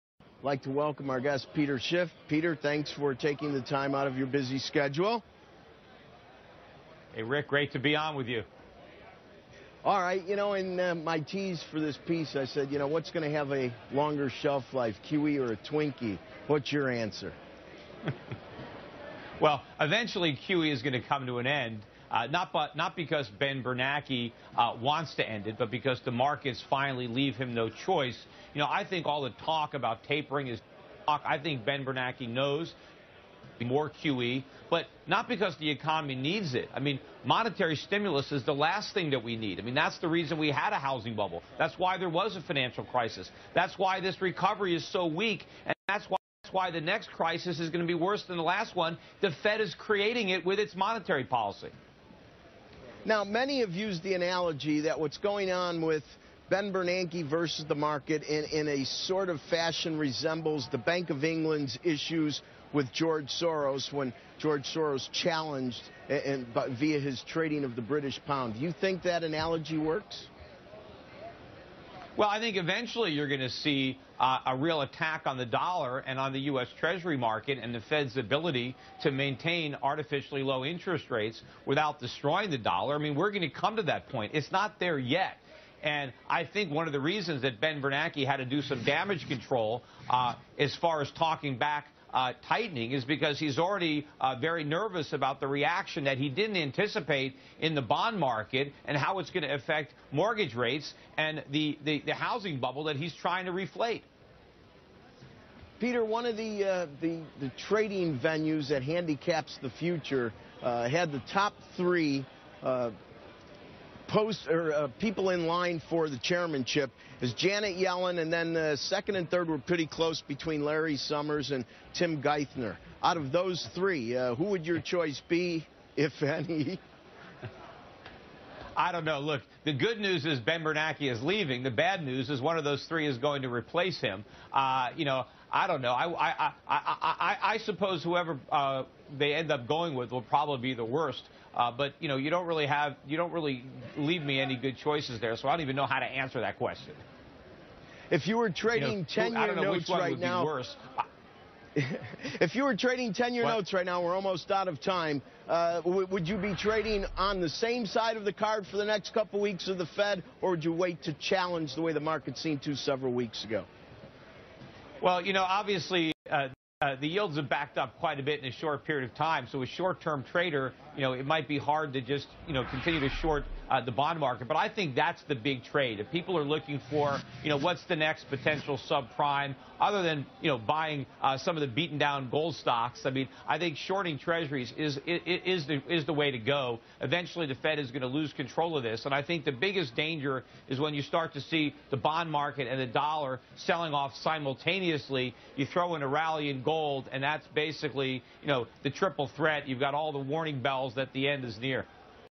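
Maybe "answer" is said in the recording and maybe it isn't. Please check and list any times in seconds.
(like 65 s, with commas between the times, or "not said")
16 s, 146 s.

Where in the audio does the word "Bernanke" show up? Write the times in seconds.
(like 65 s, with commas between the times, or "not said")
23 s, 31 s, 56 s, 87 s, 130 s.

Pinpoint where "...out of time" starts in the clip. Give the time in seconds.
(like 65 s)
154 s.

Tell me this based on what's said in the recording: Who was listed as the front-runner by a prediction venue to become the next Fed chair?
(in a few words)
Janet Yellen.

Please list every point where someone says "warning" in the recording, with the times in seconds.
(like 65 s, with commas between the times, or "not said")
200 s.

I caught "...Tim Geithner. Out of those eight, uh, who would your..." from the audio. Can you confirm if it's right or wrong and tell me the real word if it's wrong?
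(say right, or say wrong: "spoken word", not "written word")
wrong: "three", not "eight".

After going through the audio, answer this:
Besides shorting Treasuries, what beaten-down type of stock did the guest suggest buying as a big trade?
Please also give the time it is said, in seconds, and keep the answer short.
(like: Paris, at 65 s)
gold stocks, at 182 s.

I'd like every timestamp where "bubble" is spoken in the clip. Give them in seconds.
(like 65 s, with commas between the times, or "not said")
41 s, 102 s.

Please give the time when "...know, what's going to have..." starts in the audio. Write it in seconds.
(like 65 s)
12 s.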